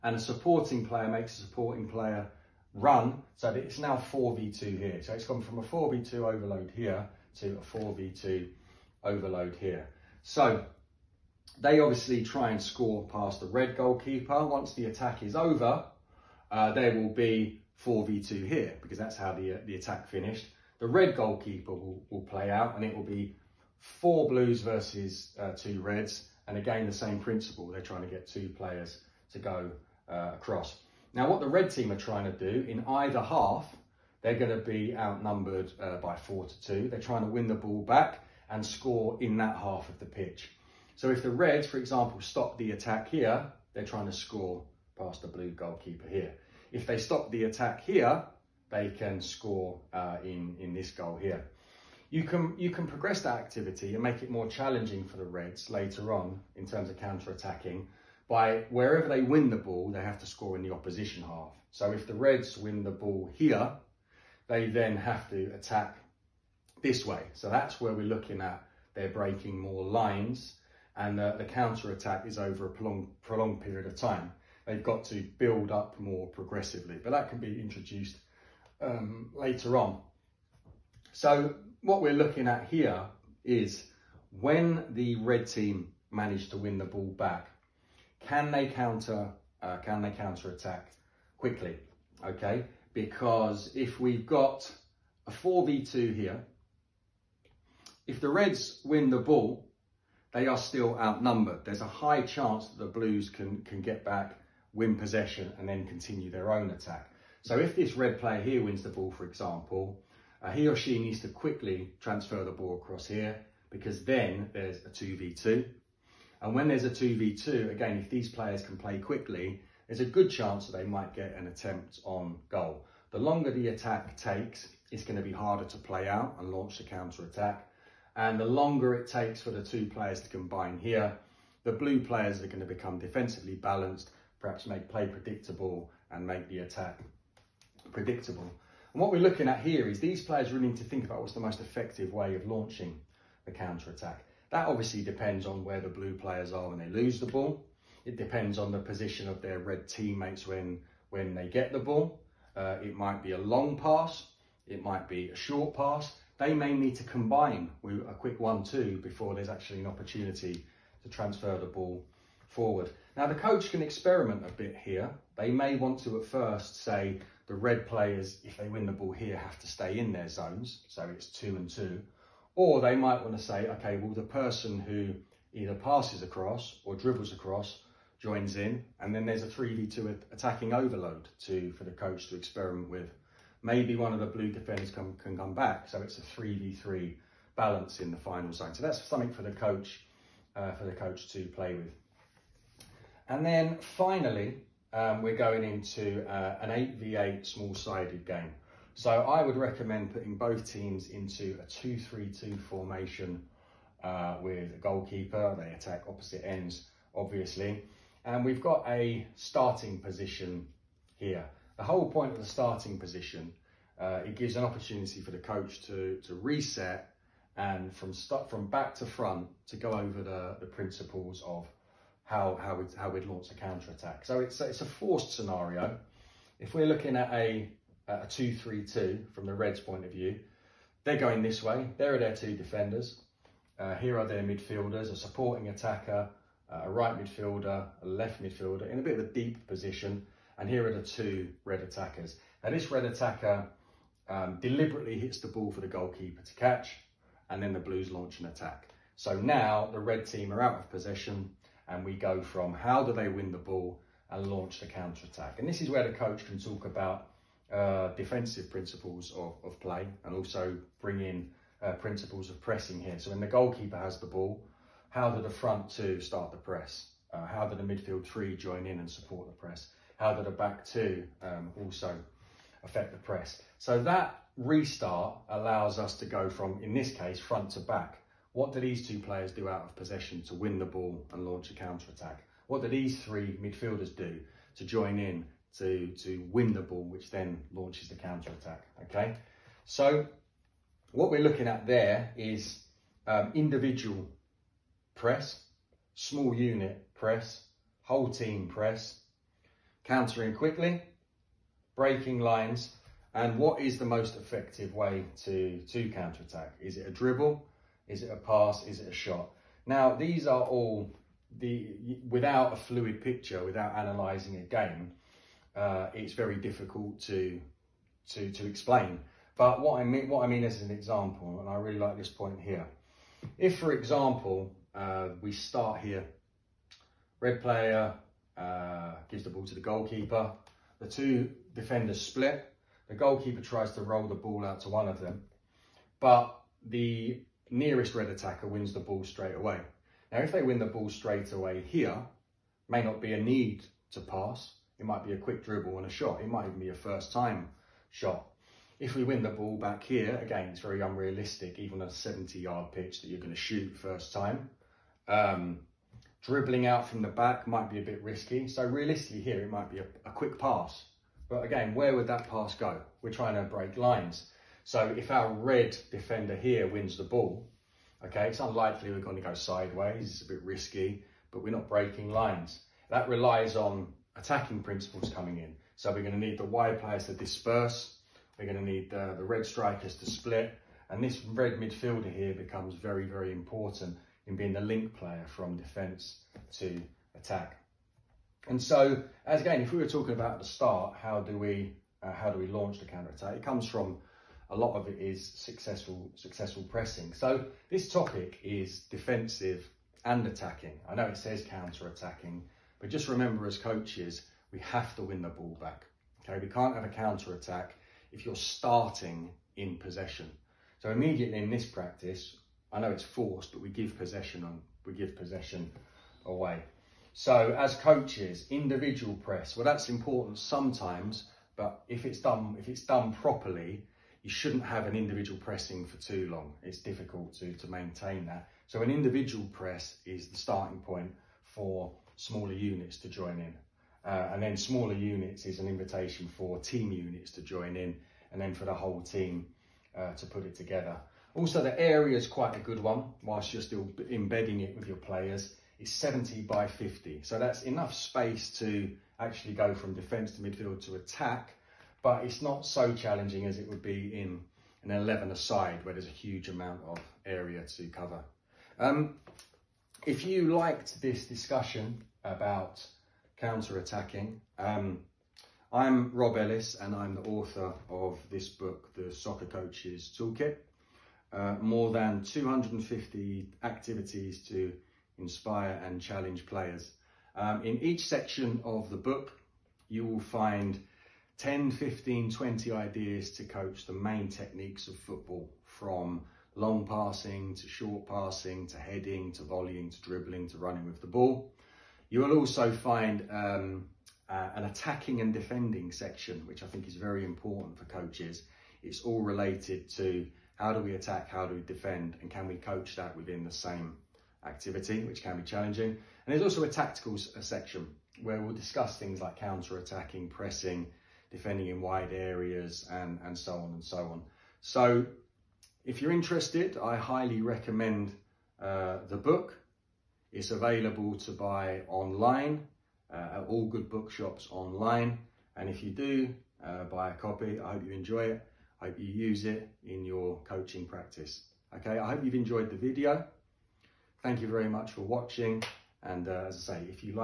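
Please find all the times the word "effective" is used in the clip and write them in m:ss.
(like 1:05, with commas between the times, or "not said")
2:21, 5:04.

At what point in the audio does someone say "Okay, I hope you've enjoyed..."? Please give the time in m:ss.
8:51.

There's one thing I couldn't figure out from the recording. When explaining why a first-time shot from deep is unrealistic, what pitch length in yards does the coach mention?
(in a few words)
70 yard.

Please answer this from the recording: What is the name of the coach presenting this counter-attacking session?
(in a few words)
Rob Ellis.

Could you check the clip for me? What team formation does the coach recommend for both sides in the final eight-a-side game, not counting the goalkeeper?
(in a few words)
2-3-2.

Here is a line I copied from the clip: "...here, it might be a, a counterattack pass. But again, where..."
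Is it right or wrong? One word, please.
wrong.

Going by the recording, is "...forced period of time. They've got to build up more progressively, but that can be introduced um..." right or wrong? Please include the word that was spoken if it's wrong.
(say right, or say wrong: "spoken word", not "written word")
wrong: "prolonged", not "forced".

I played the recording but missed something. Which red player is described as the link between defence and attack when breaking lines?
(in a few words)
This red midfielder.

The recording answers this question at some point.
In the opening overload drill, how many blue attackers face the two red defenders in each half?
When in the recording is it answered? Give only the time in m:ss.
0:23.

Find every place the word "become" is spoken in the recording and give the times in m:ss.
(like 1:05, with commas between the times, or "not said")
2:12, 6:22.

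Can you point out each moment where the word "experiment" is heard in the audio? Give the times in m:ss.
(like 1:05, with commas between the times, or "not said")
2:43, 3:02.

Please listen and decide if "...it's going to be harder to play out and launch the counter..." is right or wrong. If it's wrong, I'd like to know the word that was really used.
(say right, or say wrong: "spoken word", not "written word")
right.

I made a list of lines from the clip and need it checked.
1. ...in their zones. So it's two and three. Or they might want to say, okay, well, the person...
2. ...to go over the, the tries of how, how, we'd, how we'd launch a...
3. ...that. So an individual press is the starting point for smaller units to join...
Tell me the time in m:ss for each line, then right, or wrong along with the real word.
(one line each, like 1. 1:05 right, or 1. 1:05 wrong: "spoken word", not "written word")
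1. 2:49 wrong: "two", not "three"
2. 3:39 wrong: "principles", not "tries"
3. 7:08 right.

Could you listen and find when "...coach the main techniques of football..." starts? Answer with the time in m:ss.
8:03.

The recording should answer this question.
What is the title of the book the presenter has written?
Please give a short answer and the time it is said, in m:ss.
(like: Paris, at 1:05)
The Soccer Coach's Toolkit, at 7:49.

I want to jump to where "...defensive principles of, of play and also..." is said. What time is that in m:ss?
4:18.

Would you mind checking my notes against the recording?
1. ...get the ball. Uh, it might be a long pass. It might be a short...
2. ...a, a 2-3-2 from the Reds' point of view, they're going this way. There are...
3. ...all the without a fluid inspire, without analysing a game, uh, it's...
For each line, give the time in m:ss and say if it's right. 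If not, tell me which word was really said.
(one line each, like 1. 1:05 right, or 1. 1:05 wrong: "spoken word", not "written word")
1. 2:31 right
2. 3:47 right
3. 5:10 wrong: "picture", not "inspire".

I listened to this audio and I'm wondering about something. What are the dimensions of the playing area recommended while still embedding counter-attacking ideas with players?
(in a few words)
70 by 50.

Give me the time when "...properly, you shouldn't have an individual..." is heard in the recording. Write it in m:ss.
7:03.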